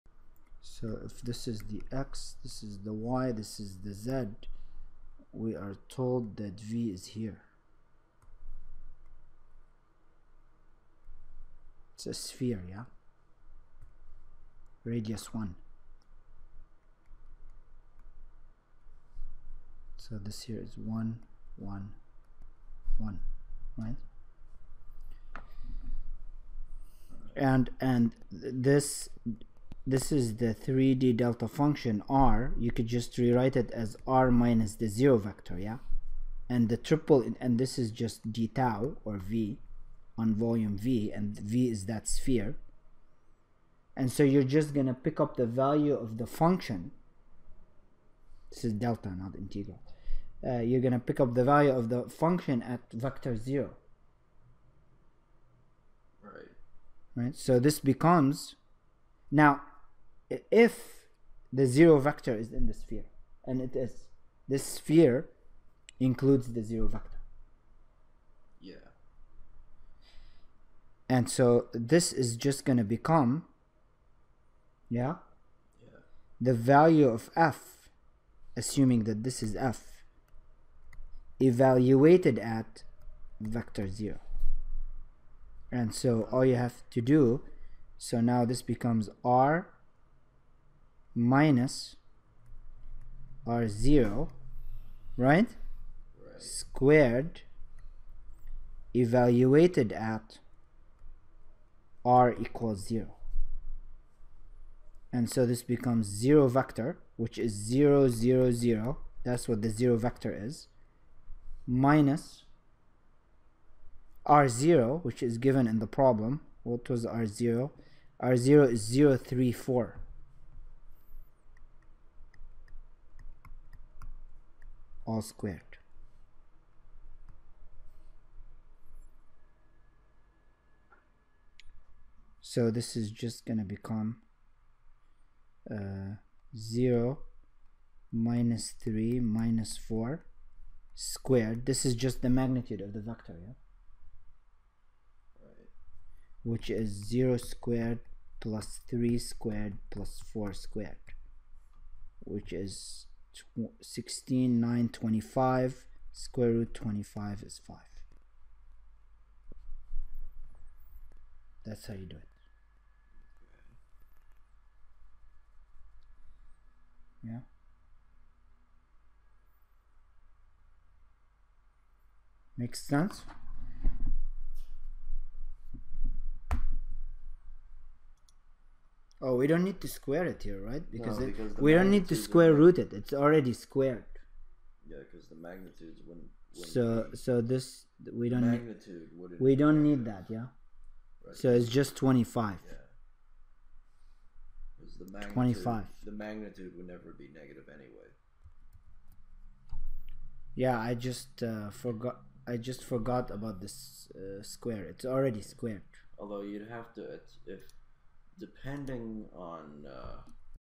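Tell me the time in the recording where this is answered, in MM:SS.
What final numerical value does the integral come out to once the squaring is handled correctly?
03:11.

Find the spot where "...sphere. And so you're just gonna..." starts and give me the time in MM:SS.
00:42.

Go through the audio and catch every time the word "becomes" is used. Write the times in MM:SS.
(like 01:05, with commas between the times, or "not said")
00:57, 01:12, 01:28, 01:45, 02:13.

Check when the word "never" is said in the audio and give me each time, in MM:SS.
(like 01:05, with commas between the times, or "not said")
03:16.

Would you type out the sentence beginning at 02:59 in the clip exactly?
Oh, we don't need to square it here, right?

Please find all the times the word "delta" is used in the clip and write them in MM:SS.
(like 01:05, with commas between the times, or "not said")
00:31, 00:48.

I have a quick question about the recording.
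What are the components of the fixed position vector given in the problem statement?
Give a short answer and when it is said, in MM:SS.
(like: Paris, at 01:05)
0, 3, 4, at 01:58.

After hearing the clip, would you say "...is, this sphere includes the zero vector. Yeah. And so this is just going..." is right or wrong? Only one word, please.
right.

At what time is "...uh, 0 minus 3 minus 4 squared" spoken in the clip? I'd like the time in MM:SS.
02:15.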